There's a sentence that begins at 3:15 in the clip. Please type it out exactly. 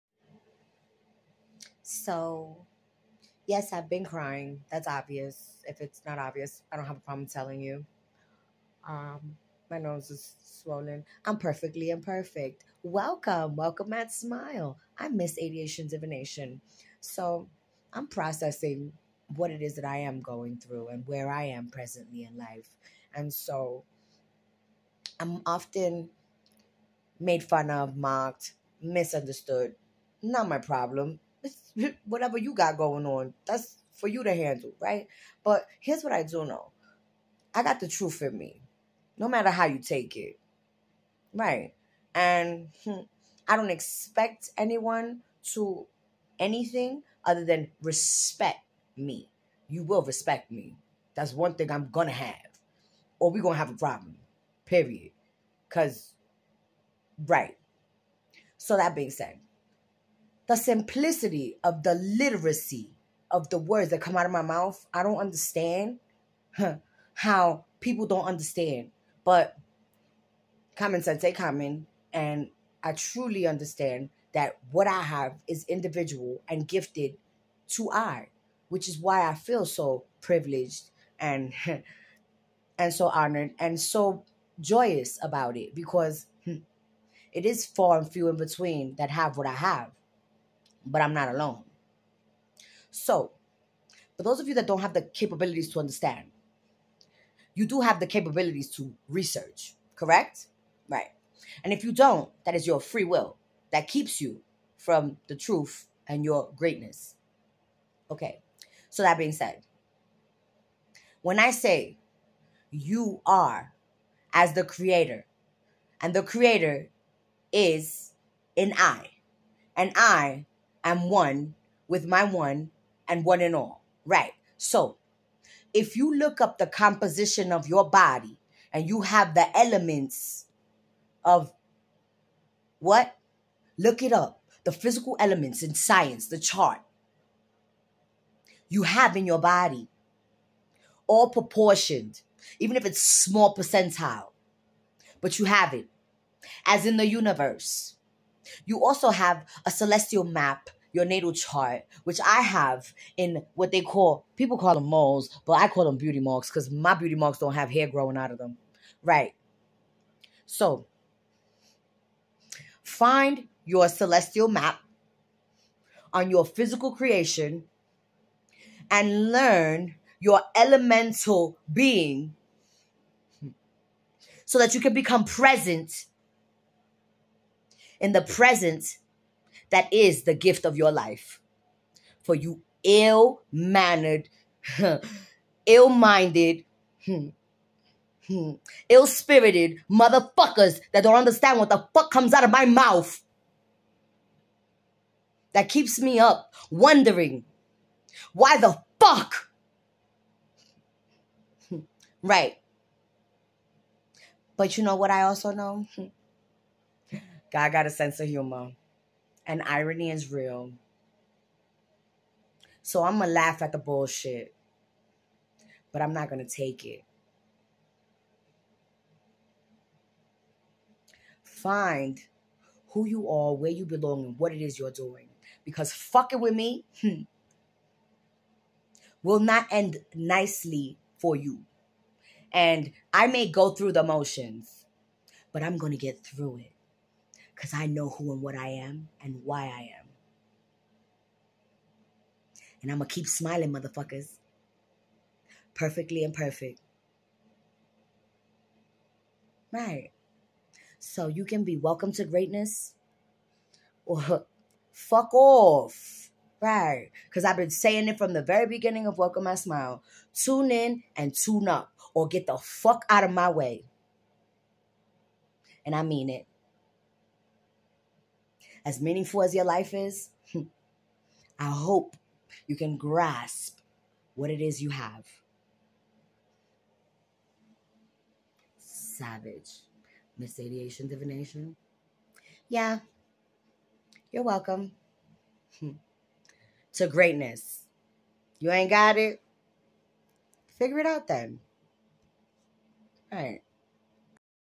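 That keeps me up wondering why the fuck.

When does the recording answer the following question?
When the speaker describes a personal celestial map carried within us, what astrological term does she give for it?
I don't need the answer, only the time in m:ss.
2:31.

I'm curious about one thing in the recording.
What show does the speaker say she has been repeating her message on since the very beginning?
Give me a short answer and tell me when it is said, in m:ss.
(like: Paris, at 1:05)
Welcome My Smile, at 4:19.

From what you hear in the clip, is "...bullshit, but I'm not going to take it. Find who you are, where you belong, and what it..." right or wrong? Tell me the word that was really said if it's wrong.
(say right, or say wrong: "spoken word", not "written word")
right.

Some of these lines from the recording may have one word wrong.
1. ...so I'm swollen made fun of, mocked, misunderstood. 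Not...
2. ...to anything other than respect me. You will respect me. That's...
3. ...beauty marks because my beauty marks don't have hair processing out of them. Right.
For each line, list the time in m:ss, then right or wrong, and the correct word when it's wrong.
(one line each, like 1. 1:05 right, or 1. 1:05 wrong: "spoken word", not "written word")
1. 0:23 wrong: "often", not "swollen"
2. 0:45 right
3. 2:35 wrong: "growing", not "processing".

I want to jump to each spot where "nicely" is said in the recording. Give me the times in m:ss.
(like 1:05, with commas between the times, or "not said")
3:50.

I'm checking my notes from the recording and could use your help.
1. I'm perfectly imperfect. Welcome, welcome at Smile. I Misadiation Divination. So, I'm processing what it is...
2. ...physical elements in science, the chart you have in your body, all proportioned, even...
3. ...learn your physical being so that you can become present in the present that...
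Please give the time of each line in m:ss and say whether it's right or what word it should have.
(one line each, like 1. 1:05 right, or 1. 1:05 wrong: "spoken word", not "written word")
1. 0:11 right
2. 2:14 right
3. 2:49 wrong: "elemental", not "physical".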